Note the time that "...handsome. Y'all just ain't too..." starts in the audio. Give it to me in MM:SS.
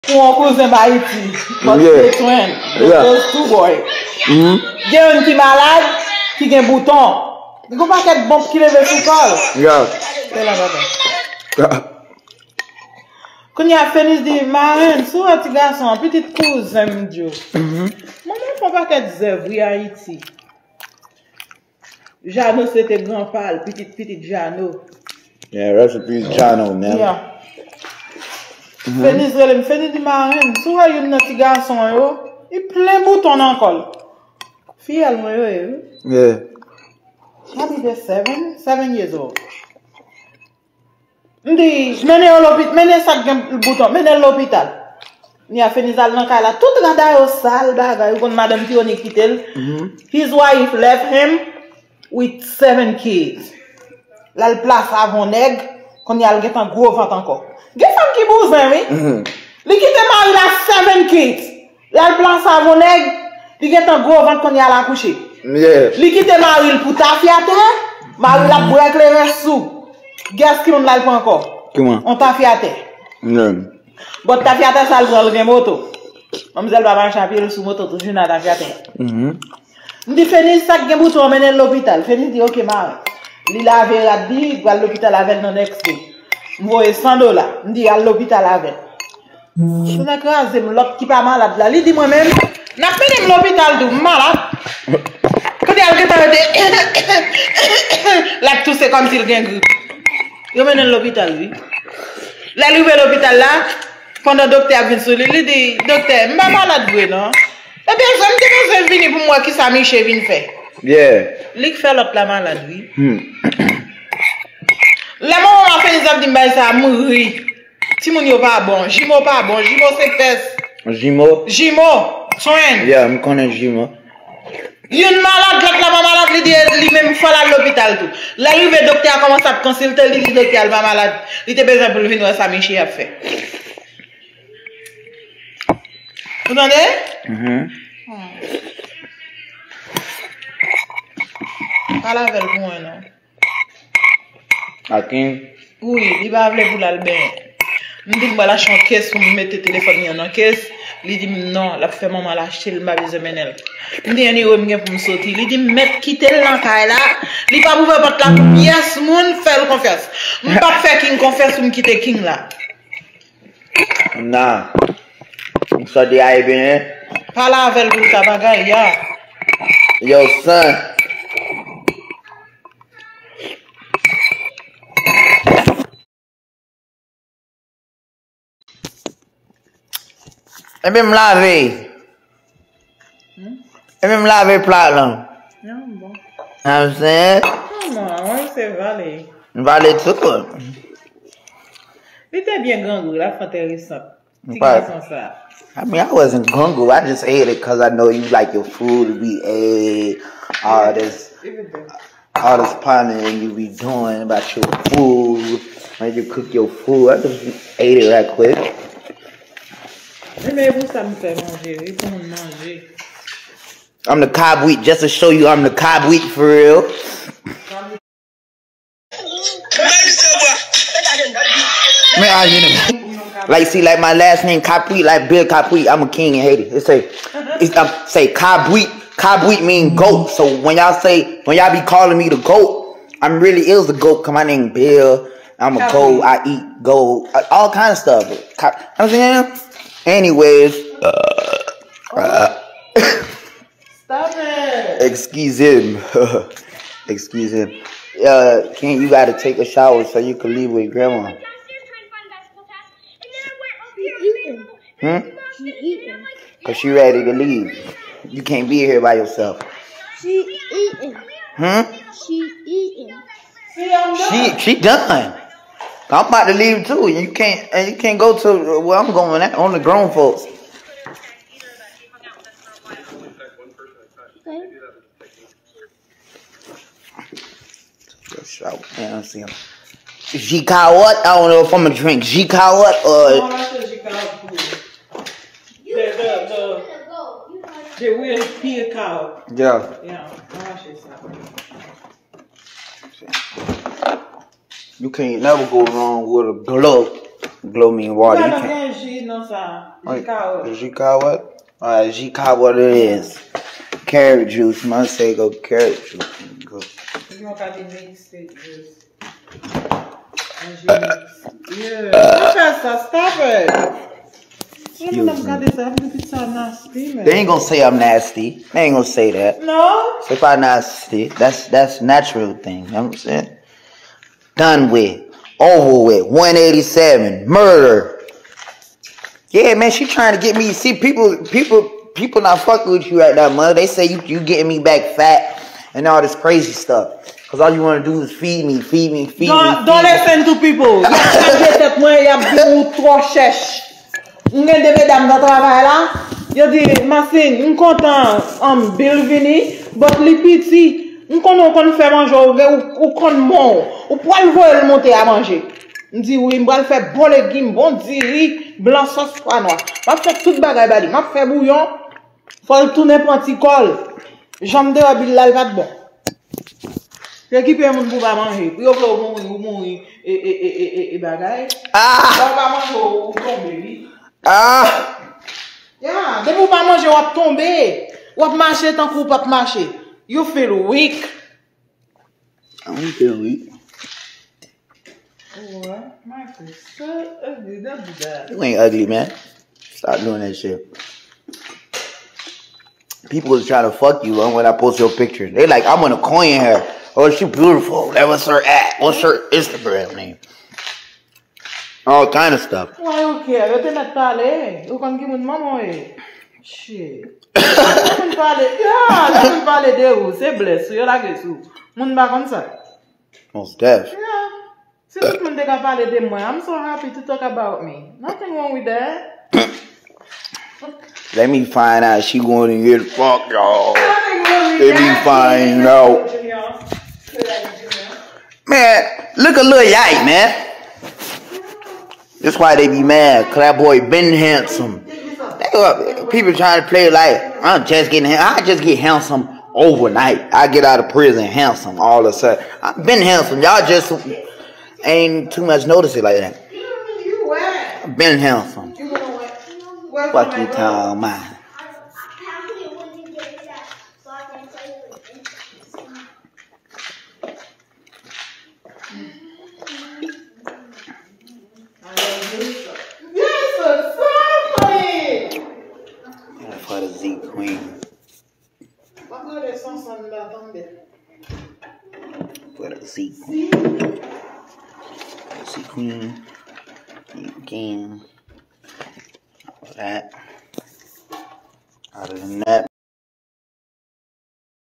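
07:23.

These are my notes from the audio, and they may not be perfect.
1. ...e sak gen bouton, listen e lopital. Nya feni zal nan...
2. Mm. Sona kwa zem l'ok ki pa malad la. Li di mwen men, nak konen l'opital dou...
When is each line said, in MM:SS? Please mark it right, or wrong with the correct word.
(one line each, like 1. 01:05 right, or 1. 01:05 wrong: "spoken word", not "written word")
1. 00:42 wrong: "menen", not "listen"
2. 01:29 wrong: "menen", not "konen".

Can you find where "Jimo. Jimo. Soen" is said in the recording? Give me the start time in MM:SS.
02:00.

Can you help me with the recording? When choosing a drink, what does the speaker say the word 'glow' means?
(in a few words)
water.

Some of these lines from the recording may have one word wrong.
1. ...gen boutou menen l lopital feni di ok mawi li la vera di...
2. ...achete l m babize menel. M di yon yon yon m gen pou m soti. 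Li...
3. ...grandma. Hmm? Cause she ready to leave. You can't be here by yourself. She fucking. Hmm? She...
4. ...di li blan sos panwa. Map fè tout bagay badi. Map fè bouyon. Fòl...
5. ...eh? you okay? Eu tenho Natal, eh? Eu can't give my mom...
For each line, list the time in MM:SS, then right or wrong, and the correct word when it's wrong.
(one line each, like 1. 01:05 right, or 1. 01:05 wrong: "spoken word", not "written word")
1. 01:20 wrong: "omenen", not "menen"
2. 02:32 right
3. 04:10 wrong: "eating", not "fucking"
4. 05:58 right
5. 06:43 right.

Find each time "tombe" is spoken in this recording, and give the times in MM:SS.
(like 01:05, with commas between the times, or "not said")
06:13, 06:17.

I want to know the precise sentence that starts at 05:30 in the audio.
See, people, people, people not fucking with you right now, mother.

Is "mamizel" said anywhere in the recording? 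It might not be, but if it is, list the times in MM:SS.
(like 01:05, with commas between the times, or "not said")
01:16.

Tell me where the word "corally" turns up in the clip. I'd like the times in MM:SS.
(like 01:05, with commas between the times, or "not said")
not said.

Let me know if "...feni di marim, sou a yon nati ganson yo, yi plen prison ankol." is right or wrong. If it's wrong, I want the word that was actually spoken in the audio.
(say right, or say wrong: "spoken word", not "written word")
wrong: "bouton", not "prison".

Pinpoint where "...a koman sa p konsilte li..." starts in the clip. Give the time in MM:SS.
02:09.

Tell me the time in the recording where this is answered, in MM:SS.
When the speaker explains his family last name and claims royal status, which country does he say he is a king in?
03:46.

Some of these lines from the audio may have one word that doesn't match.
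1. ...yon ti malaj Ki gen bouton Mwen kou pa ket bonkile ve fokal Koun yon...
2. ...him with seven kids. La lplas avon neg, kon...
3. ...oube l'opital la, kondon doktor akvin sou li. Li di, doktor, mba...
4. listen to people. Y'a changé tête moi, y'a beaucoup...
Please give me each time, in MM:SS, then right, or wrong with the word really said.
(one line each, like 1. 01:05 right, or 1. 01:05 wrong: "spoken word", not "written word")
1. 00:05 right
2. 00:51 right
3. 01:42 right
4. 05:40 right.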